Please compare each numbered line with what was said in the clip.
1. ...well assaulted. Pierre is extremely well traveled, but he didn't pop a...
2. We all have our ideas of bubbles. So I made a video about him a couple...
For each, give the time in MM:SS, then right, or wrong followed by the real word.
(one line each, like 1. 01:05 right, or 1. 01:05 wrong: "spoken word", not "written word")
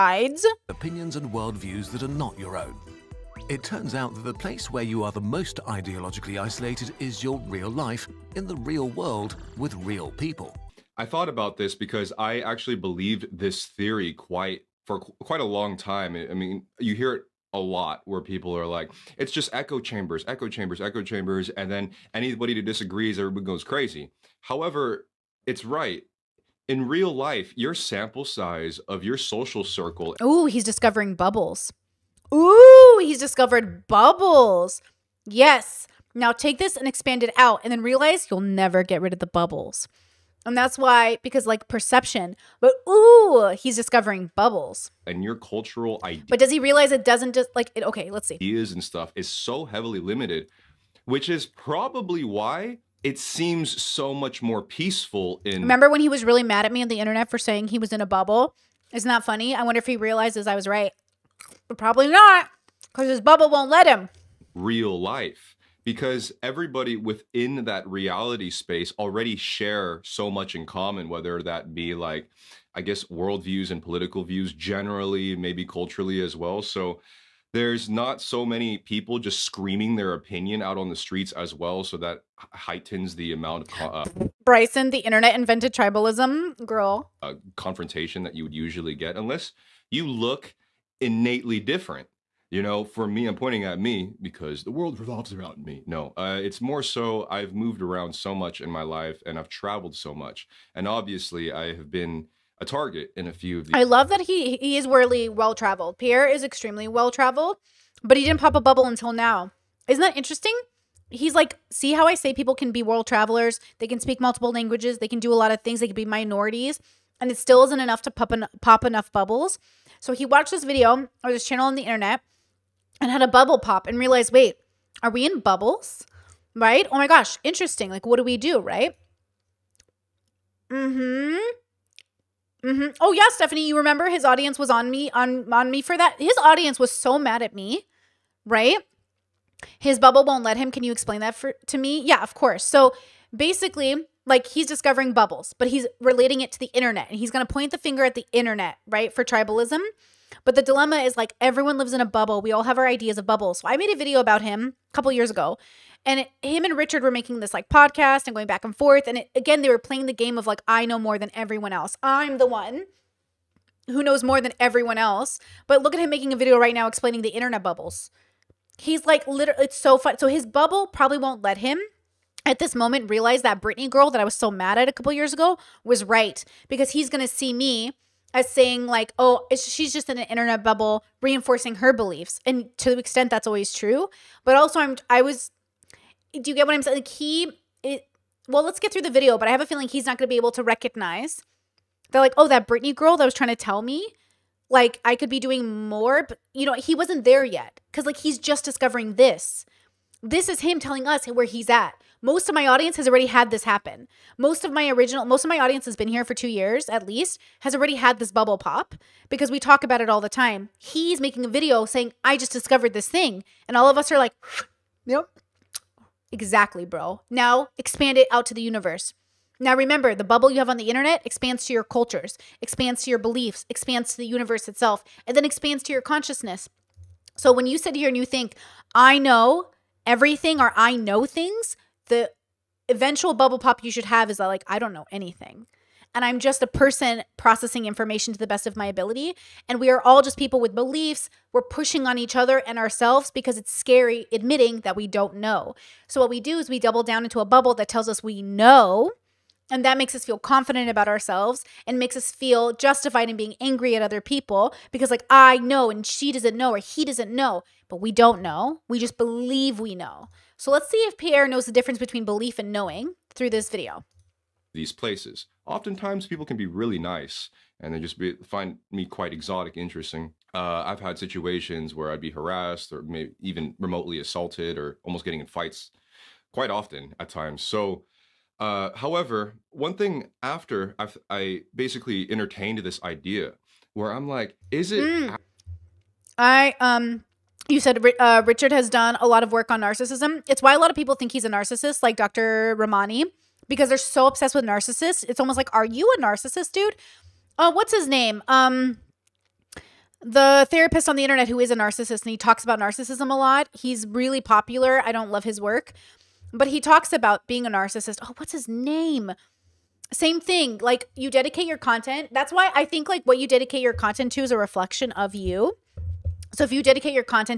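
1. 01:45 wrong: "traveled", not "assaulted"
2. 02:32 right.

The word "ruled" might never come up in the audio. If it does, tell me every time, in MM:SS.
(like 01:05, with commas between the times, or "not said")
not said.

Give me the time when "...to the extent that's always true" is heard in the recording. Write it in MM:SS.
03:02.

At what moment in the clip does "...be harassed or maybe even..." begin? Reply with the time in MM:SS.
04:32.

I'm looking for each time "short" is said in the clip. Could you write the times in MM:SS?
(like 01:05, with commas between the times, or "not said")
not said.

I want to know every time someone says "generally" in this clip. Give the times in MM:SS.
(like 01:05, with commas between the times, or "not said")
01:14.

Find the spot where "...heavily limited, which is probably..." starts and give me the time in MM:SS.
00:49.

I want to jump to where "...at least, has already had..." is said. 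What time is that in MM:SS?
03:26.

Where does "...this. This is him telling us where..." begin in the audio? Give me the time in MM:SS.
03:19.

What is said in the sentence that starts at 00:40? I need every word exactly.
And that's why, because like perception, but ooh, he's discovering bubbles.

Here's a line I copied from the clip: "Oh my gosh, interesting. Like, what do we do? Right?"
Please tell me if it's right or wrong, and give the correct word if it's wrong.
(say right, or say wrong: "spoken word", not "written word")
right.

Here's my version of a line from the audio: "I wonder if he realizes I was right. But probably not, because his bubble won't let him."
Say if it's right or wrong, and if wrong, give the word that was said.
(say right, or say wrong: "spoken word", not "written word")
right.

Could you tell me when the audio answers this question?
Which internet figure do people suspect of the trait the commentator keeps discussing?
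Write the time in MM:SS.
04:52.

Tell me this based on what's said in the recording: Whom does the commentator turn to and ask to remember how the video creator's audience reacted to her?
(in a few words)
Stephanie.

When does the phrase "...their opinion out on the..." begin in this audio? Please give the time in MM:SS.
01:19.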